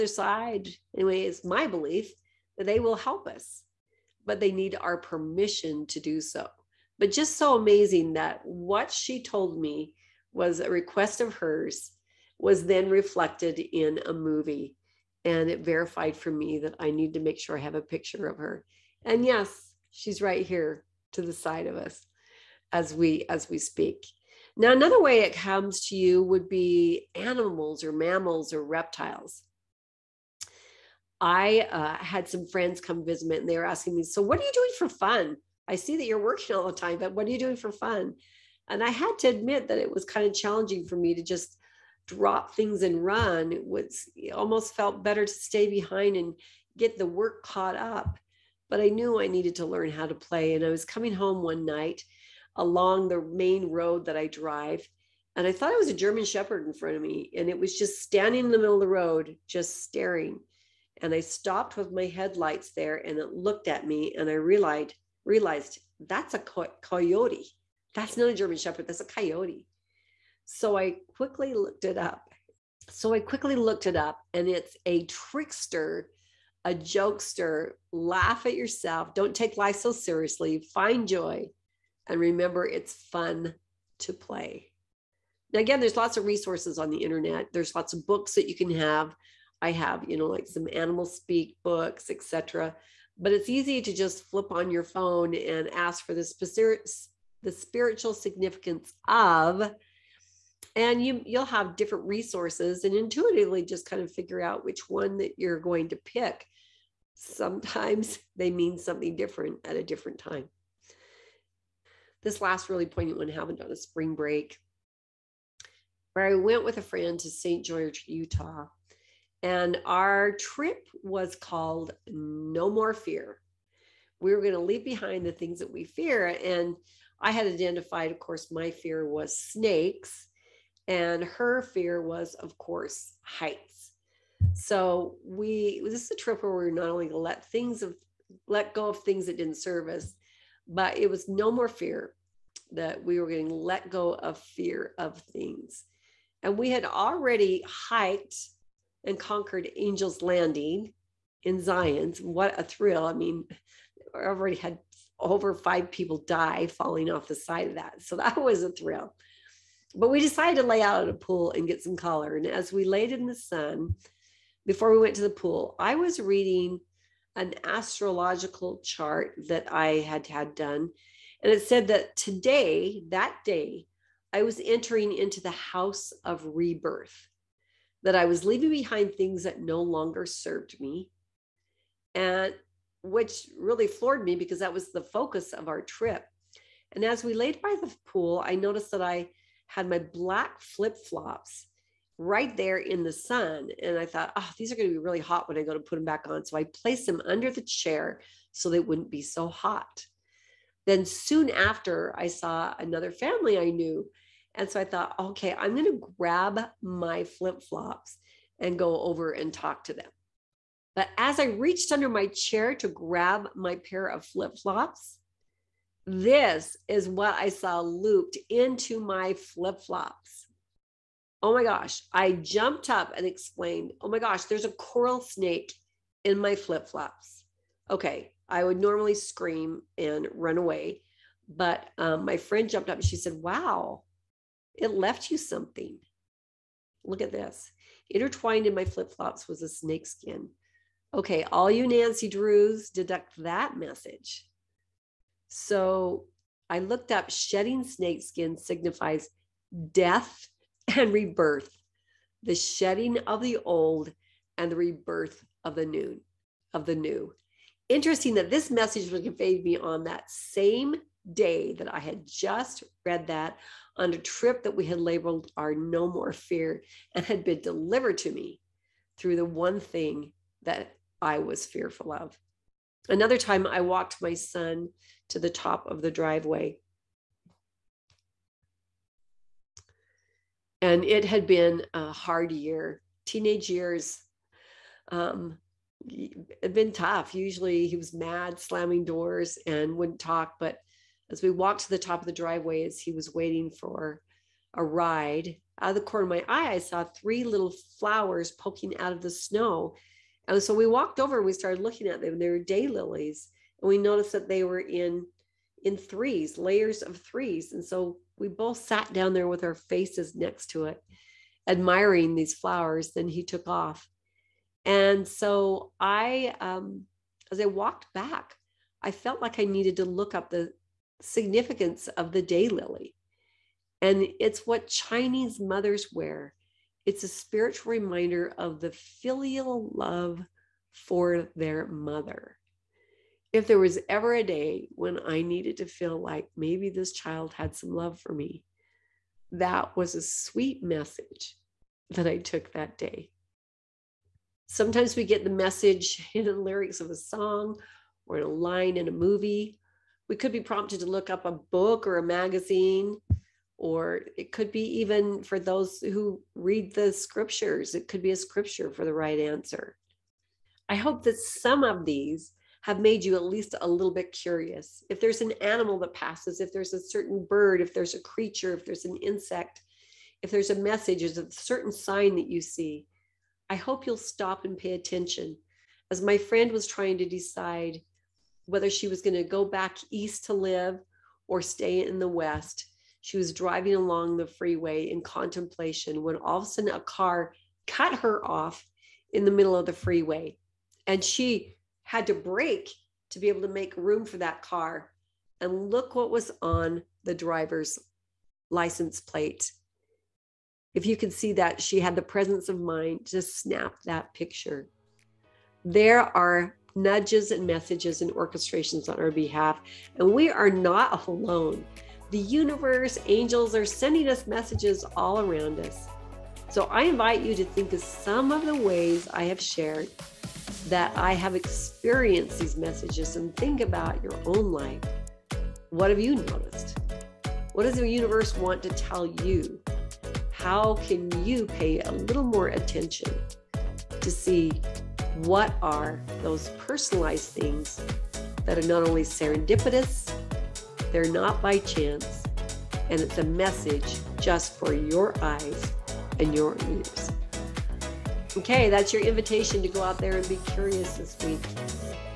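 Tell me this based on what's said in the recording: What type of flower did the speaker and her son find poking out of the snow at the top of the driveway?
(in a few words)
daylilies.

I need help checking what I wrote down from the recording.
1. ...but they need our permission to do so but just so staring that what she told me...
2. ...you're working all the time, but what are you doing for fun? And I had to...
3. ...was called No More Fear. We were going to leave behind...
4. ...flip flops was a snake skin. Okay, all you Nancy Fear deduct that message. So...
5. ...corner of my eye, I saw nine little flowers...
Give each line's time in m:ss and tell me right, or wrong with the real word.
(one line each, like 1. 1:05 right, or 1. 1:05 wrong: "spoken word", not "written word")
1. 0:04 wrong: "amazing", not "staring"
2. 0:36 right
3. 2:01 right
4. 3:58 wrong: "Drews", not "Fear"
5. 4:56 wrong: "three", not "nine".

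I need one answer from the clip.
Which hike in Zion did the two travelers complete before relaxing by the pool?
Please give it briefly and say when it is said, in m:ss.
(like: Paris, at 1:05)
Angel's Landing, at 2:29.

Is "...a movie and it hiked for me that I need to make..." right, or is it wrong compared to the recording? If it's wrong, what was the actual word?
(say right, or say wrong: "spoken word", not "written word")
wrong: "verified", not "hiked".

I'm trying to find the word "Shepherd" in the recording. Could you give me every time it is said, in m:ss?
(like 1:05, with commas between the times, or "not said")
0:56, 1:08.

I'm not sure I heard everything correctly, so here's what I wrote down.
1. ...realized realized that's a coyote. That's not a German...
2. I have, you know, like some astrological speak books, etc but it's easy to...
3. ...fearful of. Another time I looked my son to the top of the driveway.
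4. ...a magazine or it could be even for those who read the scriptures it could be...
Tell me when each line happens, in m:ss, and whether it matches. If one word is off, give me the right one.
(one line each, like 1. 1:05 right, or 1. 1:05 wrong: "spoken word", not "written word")
1. 1:04 right
2. 1:29 wrong: "animal", not "astrological"
3. 4:31 wrong: "walked", not "looked"
4. 5:52 right.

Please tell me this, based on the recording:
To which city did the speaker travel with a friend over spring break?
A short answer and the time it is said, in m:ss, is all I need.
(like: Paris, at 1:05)
St George, Utah, at 1:57.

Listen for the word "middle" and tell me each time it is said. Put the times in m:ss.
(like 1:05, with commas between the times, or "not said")
0:58, 6:29.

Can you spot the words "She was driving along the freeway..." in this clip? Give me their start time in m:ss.
6:23.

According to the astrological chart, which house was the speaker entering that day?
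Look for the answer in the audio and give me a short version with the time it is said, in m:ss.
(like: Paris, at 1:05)
house of rebirth, at 2:55.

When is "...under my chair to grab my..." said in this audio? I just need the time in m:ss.
3:31.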